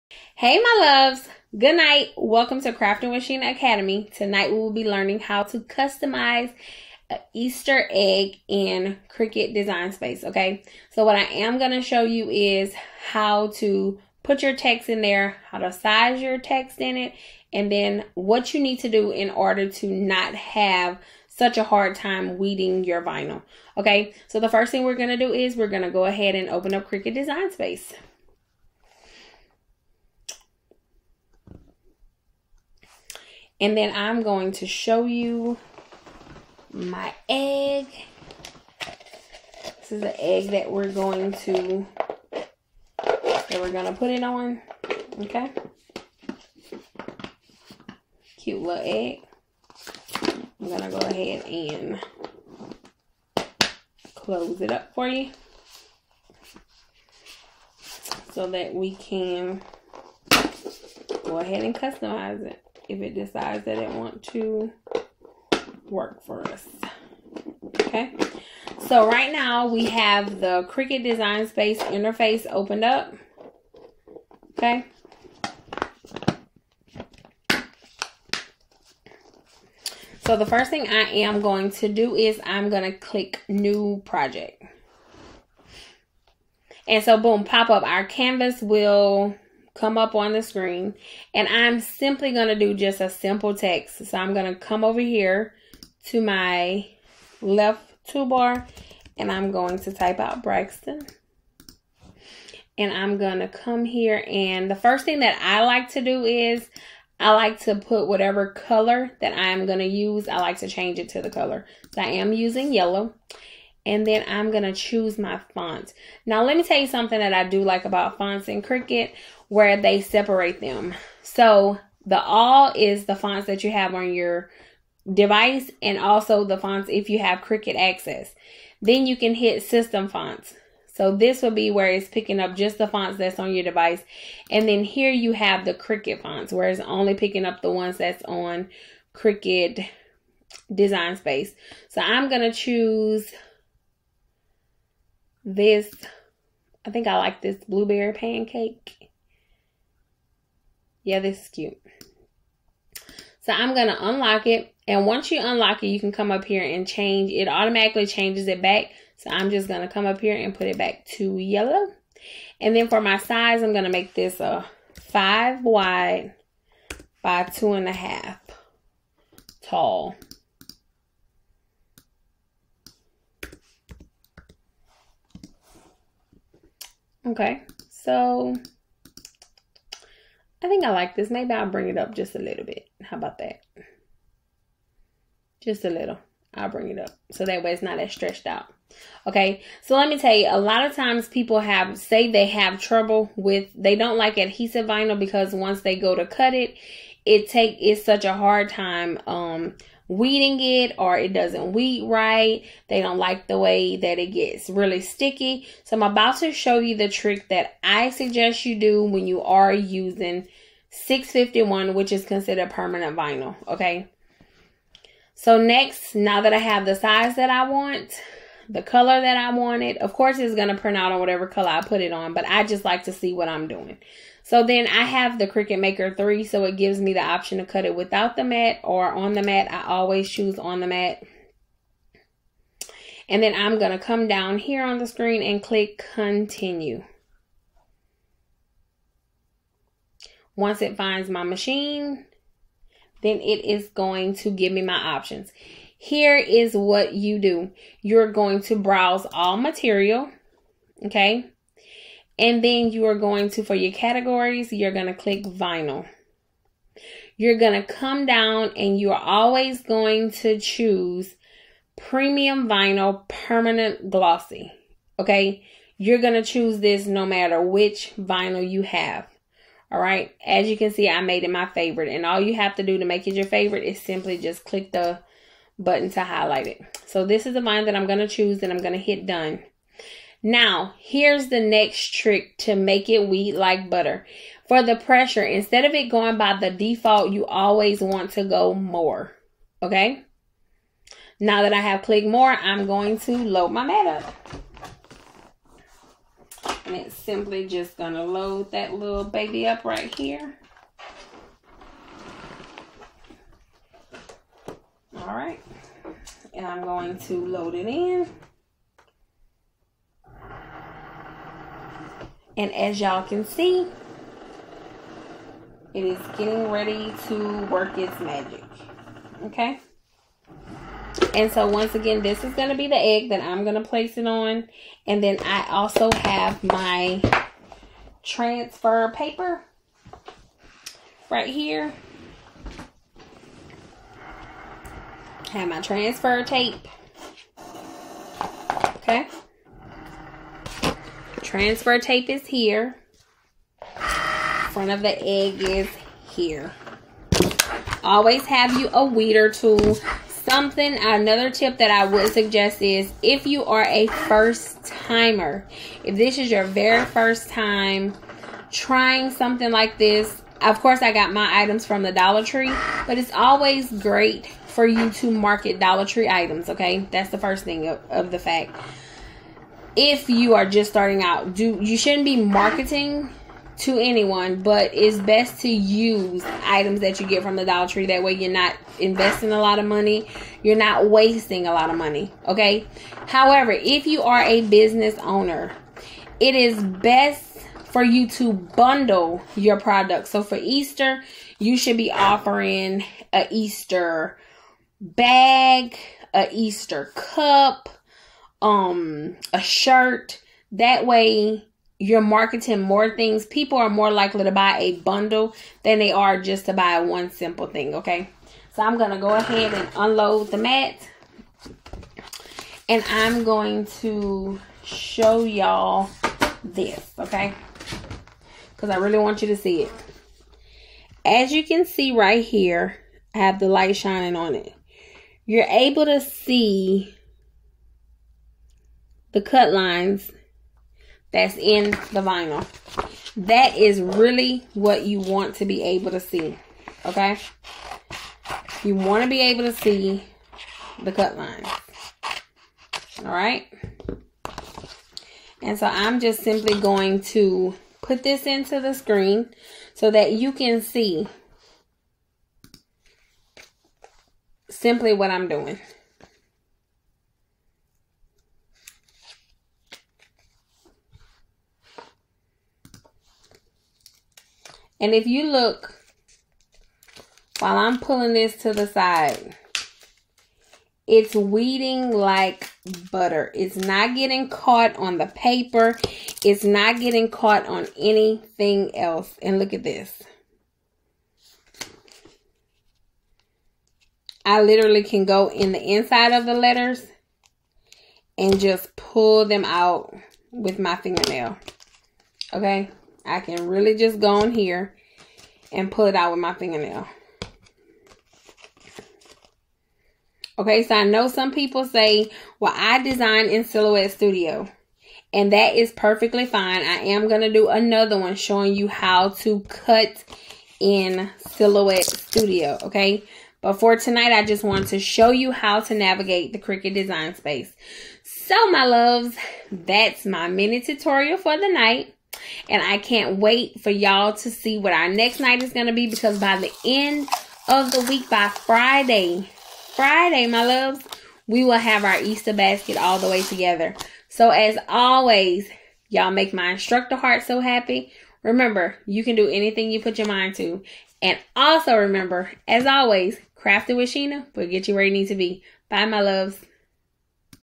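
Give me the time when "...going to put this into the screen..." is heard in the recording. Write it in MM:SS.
07:26.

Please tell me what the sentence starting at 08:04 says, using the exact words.
I literally can go in the inside of the letters and just pull them out with my fingernail.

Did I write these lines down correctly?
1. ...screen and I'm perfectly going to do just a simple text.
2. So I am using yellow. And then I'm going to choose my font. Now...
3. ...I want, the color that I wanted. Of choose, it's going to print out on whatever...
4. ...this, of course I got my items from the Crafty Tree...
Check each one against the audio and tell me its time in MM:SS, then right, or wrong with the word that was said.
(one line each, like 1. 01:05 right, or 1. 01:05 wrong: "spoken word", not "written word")
1. 01:30 wrong: "simply", not "perfectly"
2. 01:51 right
3. 03:37 wrong: "course", not "choose"
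4. 05:59 wrong: "Dollar", not "Crafty".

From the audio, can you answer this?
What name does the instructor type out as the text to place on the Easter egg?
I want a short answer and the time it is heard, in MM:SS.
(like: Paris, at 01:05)
Braxton, at 01:40.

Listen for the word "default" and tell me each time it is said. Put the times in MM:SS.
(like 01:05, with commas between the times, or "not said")
04:46.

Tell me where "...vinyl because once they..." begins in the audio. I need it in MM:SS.
03:14.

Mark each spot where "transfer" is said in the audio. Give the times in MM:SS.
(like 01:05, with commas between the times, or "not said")
05:28, 05:35, 05:41.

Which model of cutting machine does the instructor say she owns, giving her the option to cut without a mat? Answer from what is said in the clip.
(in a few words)
Cricut Maker 3.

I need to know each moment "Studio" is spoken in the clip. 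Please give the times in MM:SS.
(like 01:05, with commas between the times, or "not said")
08:24, 08:32.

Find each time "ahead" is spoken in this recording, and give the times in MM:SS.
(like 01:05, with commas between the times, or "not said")
00:26, 00:50, 01:01, 06:49.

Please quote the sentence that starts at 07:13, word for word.
That is really what you want to be able to see, okay?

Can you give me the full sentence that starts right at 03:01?
Maybe I'll bring it up just a little bit.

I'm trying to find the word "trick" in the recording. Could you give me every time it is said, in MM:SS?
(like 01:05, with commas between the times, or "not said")
03:27, 04:42.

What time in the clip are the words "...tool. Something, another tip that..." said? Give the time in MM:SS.
05:49.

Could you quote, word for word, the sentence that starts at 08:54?
So as always, y'all make my instructor heart so happy.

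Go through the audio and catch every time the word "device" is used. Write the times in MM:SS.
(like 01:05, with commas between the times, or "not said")
02:05, 02:13.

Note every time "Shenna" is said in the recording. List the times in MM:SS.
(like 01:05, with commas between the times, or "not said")
00:03, 09:04.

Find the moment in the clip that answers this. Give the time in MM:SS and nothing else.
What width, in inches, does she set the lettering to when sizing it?
02:45.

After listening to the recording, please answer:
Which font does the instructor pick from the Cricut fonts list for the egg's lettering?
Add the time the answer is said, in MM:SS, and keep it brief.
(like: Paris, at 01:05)
Blueberry Pancake, at 02:27.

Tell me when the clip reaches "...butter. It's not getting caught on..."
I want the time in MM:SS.
07:53.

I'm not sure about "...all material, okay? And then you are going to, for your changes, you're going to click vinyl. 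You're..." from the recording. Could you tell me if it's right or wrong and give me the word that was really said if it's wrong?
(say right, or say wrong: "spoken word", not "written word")
wrong: "categories", not "changes".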